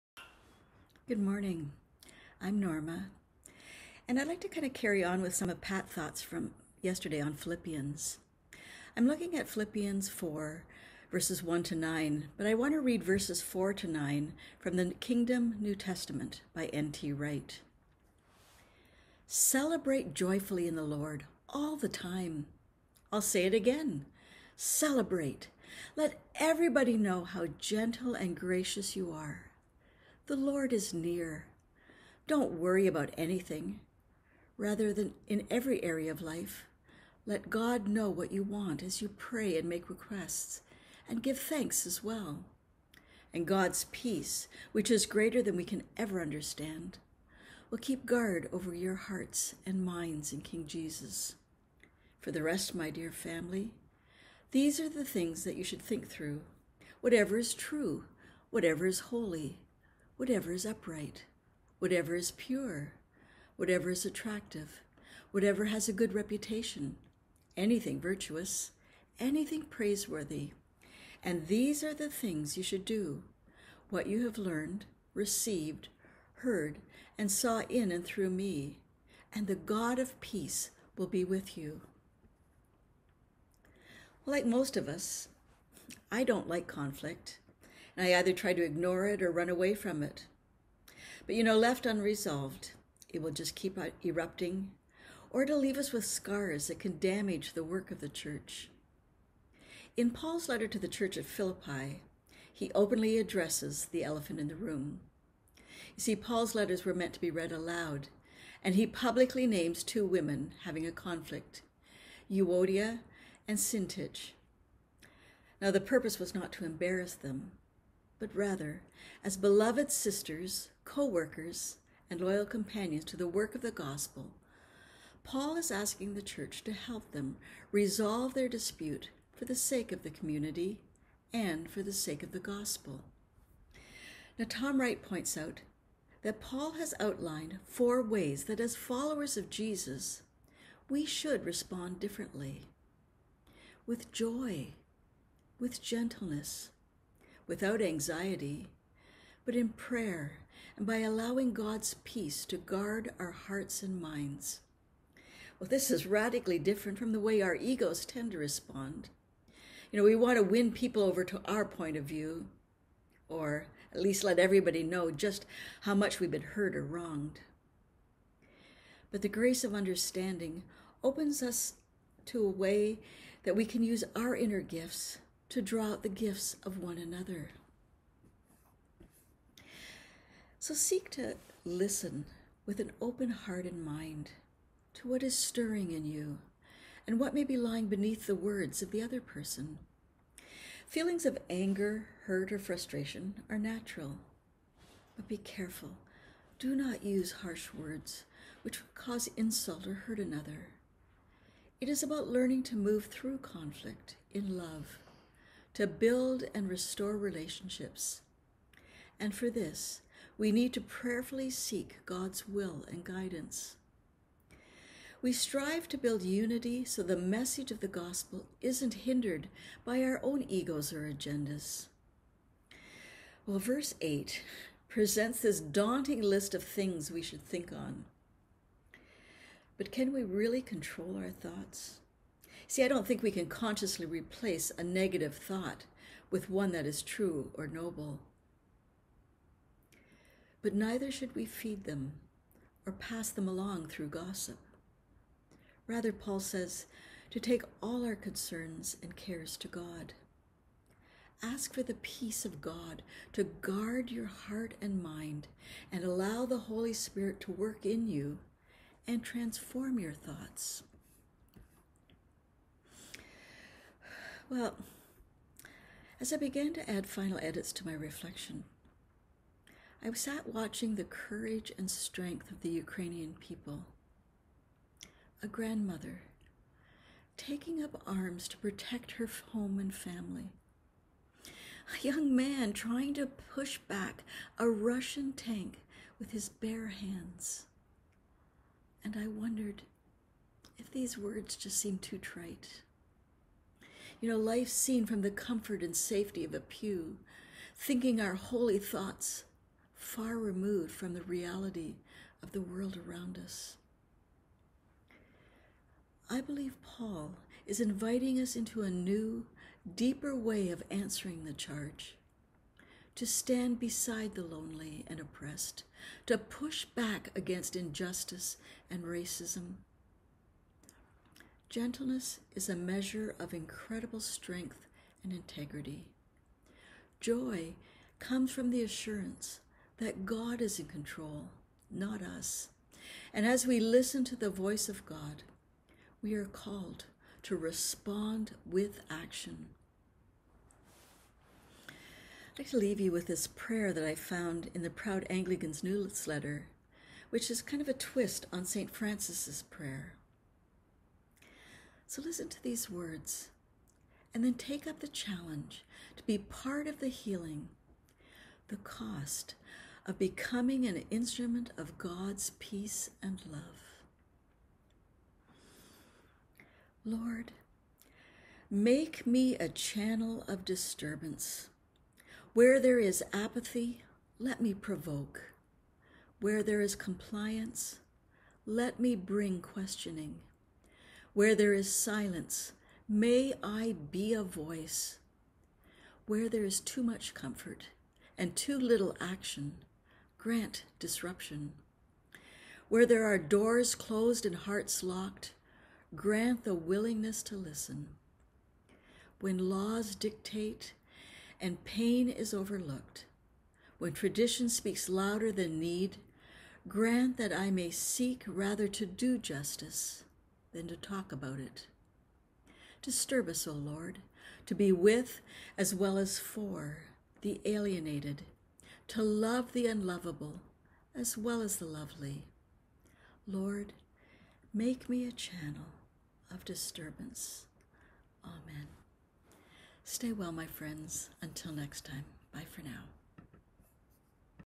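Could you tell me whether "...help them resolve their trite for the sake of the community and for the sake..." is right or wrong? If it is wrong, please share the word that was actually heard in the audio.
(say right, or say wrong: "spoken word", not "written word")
wrong: "dispute", not "trite".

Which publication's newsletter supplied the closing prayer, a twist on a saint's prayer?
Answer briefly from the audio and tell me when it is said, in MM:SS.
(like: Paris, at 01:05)
Proud Anglican's, at 05:44.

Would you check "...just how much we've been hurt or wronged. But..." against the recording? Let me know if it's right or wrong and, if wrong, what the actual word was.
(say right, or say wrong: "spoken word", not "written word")
right.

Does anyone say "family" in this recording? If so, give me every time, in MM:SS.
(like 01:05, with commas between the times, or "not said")
00:53, 04:39.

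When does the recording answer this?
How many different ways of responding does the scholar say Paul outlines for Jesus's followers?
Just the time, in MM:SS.
02:17.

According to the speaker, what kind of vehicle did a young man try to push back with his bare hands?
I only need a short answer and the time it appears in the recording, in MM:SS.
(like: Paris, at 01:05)
Russian tank, at 04:44.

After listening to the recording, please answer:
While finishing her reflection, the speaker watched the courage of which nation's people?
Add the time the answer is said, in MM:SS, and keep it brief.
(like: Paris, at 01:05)
Ukrainian, at 04:32.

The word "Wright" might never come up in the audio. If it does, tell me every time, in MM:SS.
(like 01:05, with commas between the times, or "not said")
00:17, 02:14.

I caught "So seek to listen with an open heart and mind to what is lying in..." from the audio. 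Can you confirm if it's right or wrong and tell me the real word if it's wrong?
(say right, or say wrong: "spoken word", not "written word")
wrong: "stirring", not "lying".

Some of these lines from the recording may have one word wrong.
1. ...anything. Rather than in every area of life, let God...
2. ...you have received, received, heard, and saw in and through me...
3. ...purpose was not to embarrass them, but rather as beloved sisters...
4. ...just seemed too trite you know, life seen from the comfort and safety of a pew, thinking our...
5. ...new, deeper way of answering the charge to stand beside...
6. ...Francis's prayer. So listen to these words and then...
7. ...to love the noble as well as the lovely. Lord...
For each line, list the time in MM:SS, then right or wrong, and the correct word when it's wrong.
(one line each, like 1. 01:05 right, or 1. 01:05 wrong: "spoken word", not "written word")
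1. 00:33 right
2. 01:14 wrong: "learned", not "received"
3. 01:55 right
4. 04:51 right
5. 05:08 right
6. 05:48 right
7. 06:59 wrong: "unlovable", not "noble".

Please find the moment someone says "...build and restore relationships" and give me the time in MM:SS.
03:25.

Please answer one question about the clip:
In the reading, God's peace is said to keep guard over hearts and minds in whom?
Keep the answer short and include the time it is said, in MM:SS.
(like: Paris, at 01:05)
King Jesus, at 00:50.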